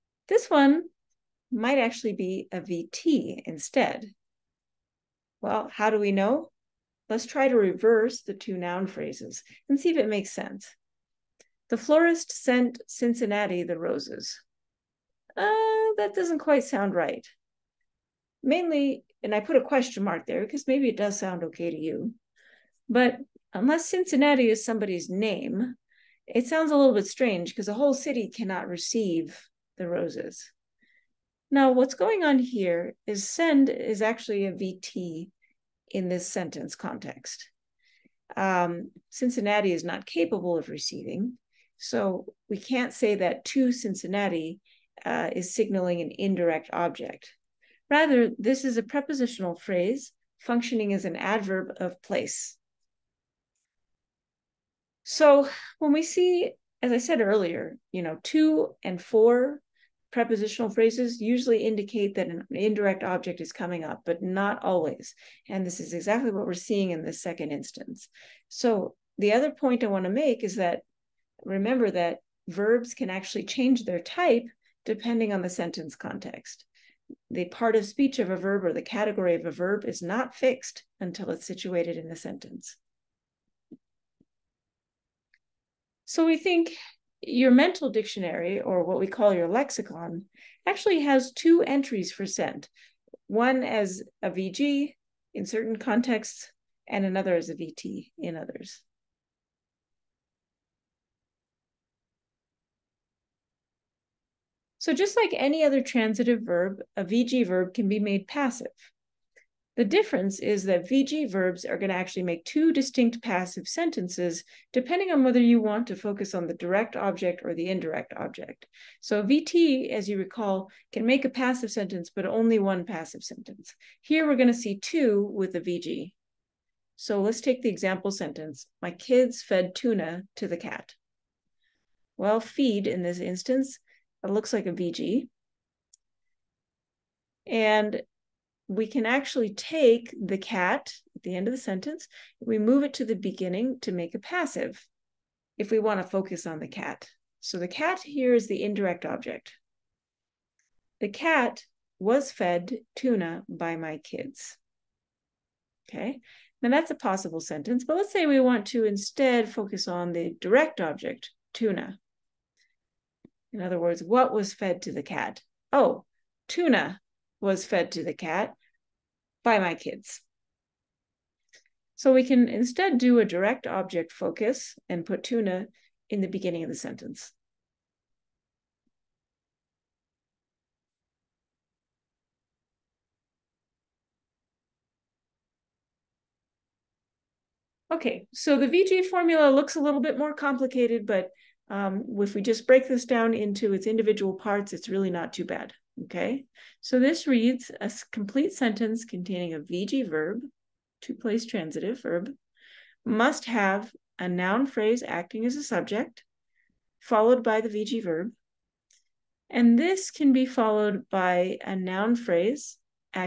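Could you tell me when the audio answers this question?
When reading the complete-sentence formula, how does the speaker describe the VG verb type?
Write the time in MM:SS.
03:21.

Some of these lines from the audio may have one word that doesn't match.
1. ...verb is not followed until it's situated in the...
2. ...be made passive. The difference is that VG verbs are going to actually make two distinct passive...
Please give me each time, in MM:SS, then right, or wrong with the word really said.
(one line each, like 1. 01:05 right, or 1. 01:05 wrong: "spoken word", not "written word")
1. 01:19 wrong: "fixed", not "followed"
2. 01:47 right.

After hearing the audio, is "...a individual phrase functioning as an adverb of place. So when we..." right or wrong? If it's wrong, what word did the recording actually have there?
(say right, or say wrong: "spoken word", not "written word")
wrong: "prepositional", not "individual".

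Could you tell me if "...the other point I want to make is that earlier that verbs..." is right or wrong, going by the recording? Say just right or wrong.
wrong.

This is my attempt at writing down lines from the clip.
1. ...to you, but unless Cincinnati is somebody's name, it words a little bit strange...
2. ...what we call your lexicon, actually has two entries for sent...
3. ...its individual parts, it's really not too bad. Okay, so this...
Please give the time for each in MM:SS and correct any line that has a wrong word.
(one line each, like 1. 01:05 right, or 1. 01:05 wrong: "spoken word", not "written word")
1. 00:21 wrong: "sounds", not "words"
2. 01:28 right
3. 03:13 right.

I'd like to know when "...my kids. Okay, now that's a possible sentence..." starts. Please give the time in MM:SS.
02:33.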